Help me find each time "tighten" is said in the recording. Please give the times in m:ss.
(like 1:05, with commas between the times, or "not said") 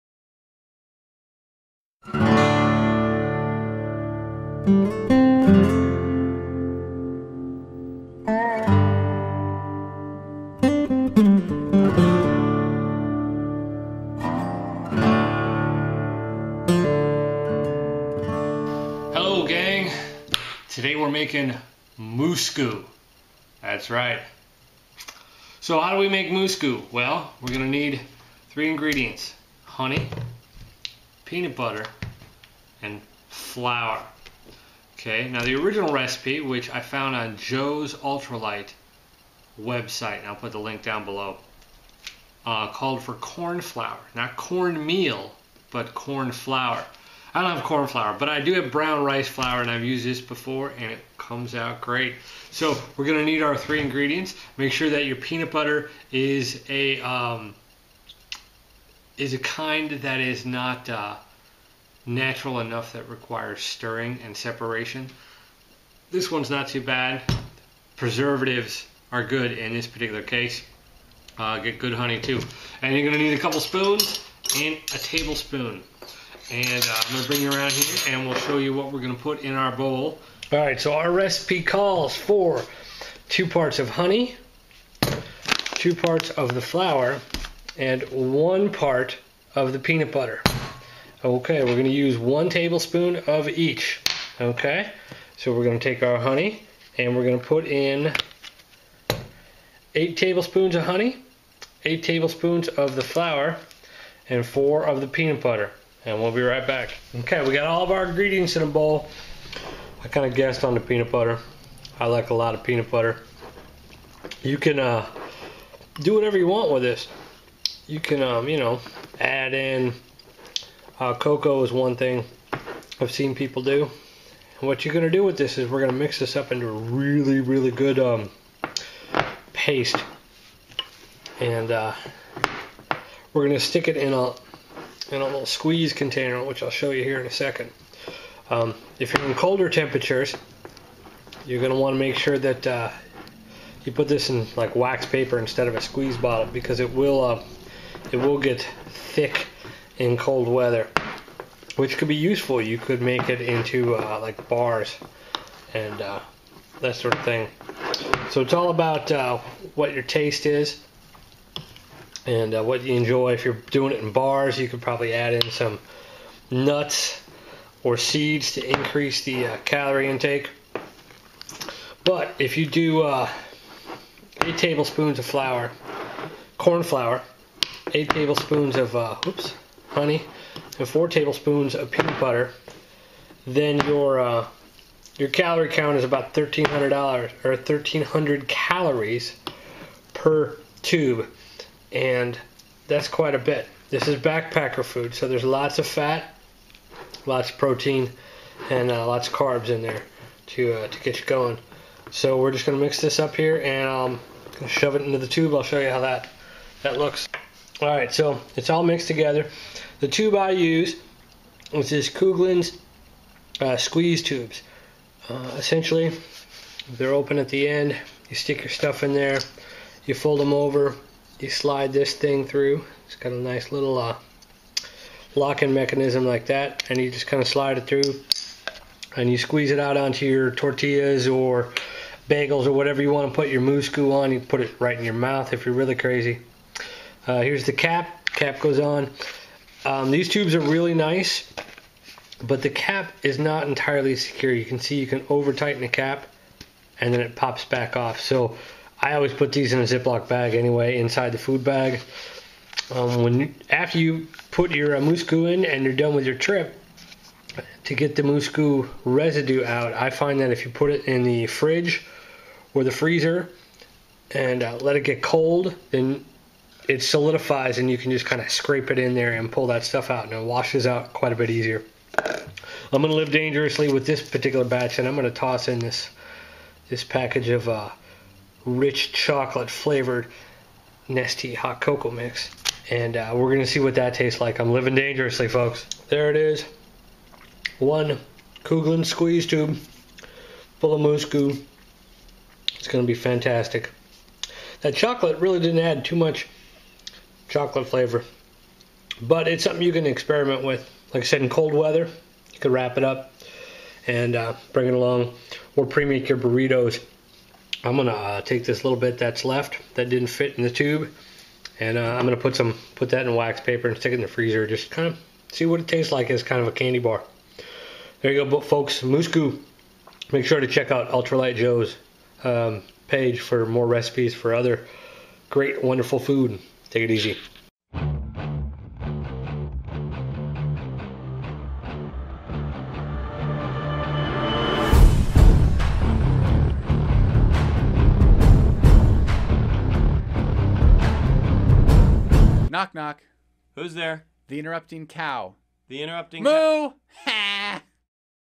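4:05.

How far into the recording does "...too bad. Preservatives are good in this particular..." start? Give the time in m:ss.
1:06.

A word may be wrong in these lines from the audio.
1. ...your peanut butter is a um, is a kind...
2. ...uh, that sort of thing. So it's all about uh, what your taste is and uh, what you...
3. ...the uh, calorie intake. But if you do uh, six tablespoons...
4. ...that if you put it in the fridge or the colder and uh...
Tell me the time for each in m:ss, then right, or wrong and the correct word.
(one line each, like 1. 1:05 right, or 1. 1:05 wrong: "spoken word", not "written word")
1. 0:55 right
2. 2:36 right
3. 2:49 wrong: "eight", not "six"
4. 4:20 wrong: "freezer", not "colder".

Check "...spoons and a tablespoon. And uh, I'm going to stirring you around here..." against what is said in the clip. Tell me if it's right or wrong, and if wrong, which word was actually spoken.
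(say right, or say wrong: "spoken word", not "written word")
wrong: "bring", not "stirring".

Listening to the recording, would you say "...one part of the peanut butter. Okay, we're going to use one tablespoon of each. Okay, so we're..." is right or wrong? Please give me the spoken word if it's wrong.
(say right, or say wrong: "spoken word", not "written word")
right.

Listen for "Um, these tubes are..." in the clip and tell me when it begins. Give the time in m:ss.
3:59.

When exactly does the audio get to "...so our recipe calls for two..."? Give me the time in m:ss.
1:20.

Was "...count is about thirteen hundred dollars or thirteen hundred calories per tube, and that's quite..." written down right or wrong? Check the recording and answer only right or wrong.
right.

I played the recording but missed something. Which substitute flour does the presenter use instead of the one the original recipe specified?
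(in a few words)
brown rice flour.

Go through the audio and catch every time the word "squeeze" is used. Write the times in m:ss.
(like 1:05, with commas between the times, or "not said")
2:15, 2:25, 3:33, 3:49, 4:49.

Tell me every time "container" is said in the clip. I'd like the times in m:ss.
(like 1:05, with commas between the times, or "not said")
2:15.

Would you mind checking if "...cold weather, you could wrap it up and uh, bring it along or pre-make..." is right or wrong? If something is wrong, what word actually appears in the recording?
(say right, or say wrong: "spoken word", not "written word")
right.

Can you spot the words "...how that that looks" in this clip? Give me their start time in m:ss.
3:25.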